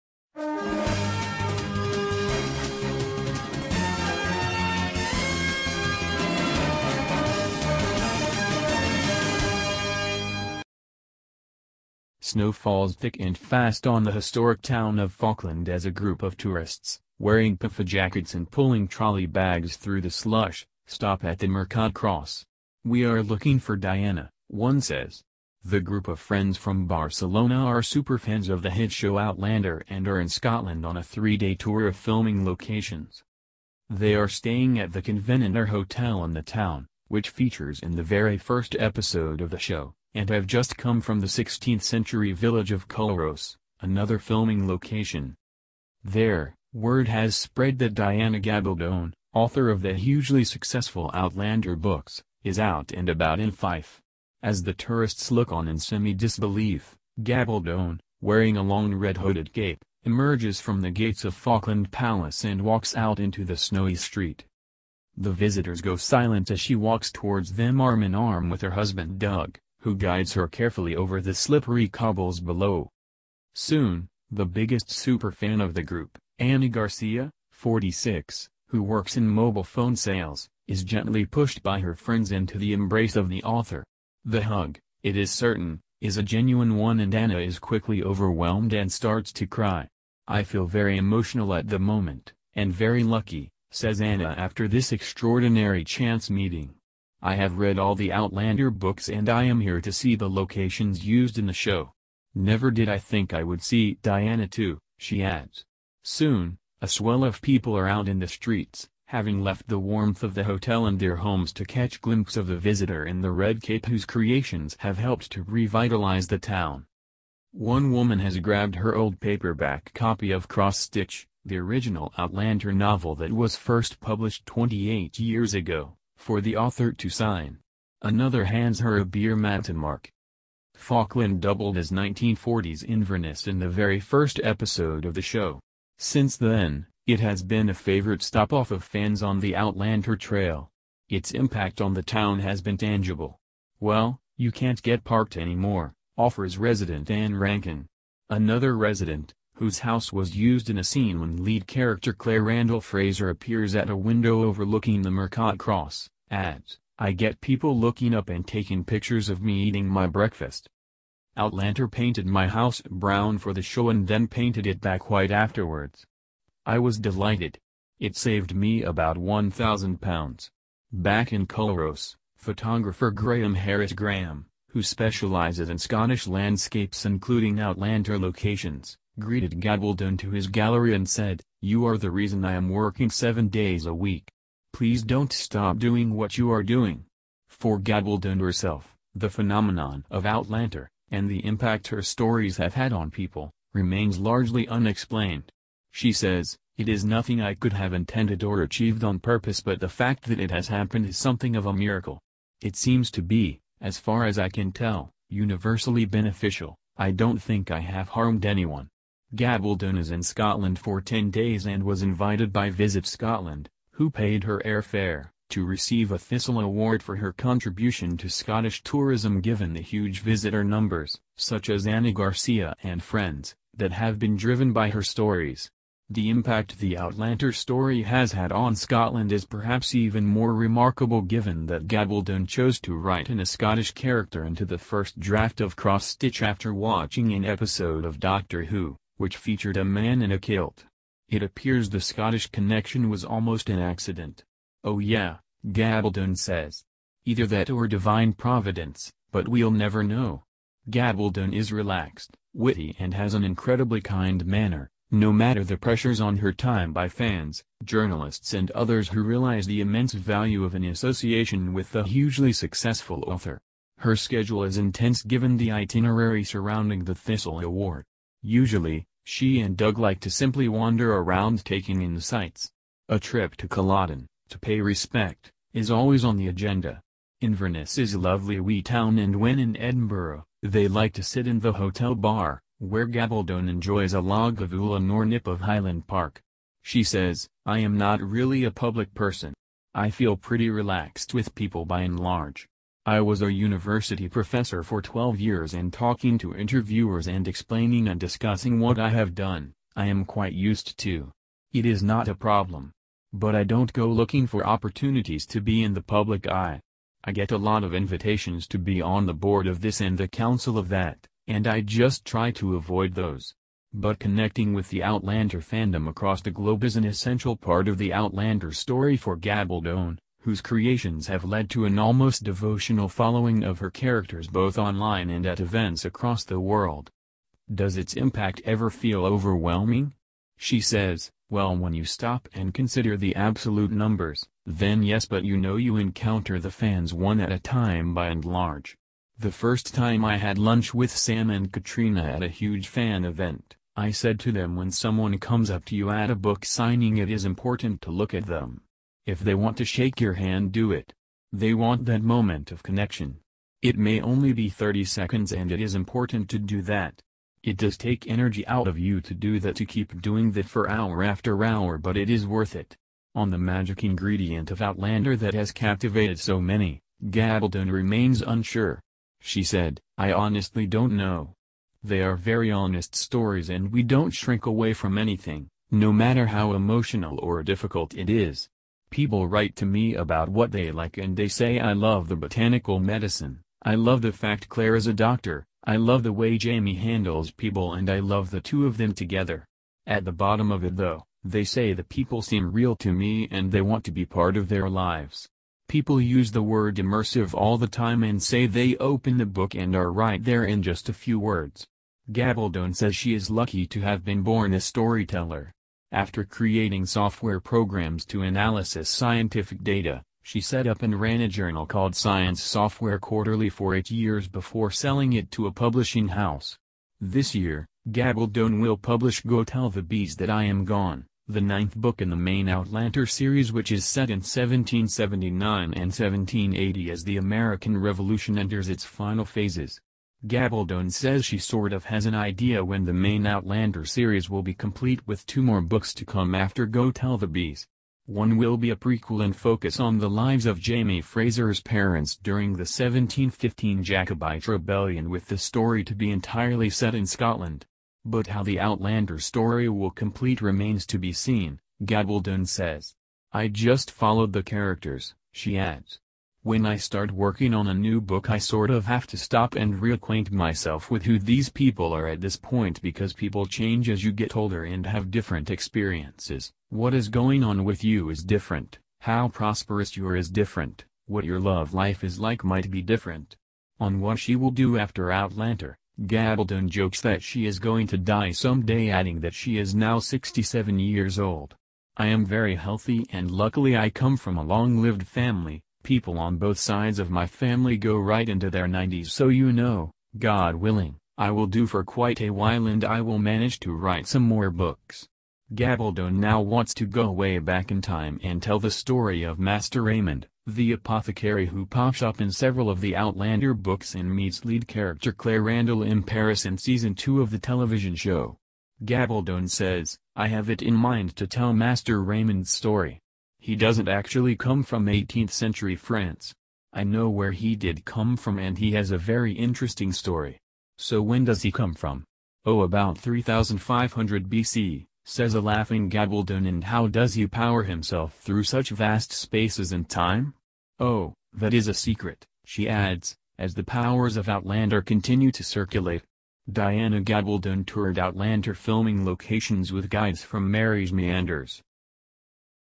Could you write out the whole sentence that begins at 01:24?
The hug, it is certain, is a genuine one and Anna is quickly overwhelmed and starts to cry.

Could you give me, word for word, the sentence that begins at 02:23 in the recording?
Well, you can't get parked anymore, offers resident Anne Rankin.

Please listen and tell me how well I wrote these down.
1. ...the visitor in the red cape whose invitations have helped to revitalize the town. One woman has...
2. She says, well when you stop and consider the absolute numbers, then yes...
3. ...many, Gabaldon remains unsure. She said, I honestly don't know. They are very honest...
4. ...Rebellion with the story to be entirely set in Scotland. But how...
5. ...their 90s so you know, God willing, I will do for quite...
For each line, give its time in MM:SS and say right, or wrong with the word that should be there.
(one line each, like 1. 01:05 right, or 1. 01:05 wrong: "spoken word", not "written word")
1. 01:52 wrong: "creations", not "invitations"
2. 05:30 right
3. 06:06 right
4. 07:24 right
5. 08:08 right.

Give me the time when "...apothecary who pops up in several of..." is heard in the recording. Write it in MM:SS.
08:20.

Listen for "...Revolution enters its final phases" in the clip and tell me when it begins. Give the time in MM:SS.
07:07.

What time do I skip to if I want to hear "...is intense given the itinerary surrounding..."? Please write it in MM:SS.
04:24.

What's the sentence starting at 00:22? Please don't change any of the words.
We are looking for Diana, one says.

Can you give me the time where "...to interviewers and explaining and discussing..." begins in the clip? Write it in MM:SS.
04:56.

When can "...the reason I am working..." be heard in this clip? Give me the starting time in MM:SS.
03:01.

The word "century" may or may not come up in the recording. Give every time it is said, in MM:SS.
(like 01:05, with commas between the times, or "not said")
00:41, 08:35.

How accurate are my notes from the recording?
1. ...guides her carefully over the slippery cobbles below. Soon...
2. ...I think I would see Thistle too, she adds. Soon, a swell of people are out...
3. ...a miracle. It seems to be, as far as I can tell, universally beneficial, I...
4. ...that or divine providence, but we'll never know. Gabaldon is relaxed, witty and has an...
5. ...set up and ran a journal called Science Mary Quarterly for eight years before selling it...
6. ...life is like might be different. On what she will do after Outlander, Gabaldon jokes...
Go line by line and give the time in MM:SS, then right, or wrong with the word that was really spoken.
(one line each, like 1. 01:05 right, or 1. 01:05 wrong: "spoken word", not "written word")
1. 01:09 right
2. 01:42 wrong: "Diana", not "Thistle"
3. 03:21 right
4. 04:07 right
5. 06:50 wrong: "Software", not "Mary"
6. 07:51 right.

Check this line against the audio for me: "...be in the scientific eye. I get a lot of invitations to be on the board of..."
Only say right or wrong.
wrong.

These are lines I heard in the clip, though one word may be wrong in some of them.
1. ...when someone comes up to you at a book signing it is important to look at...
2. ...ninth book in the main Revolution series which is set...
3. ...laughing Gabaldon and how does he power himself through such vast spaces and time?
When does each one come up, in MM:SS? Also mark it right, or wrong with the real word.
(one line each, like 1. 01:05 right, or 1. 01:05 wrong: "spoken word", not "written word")
1. 05:44 right
2. 07:01 wrong: "Outlander", not "Revolution"
3. 08:45 right.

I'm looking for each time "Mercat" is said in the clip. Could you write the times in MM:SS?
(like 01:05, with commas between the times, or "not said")
00:21, 02:35.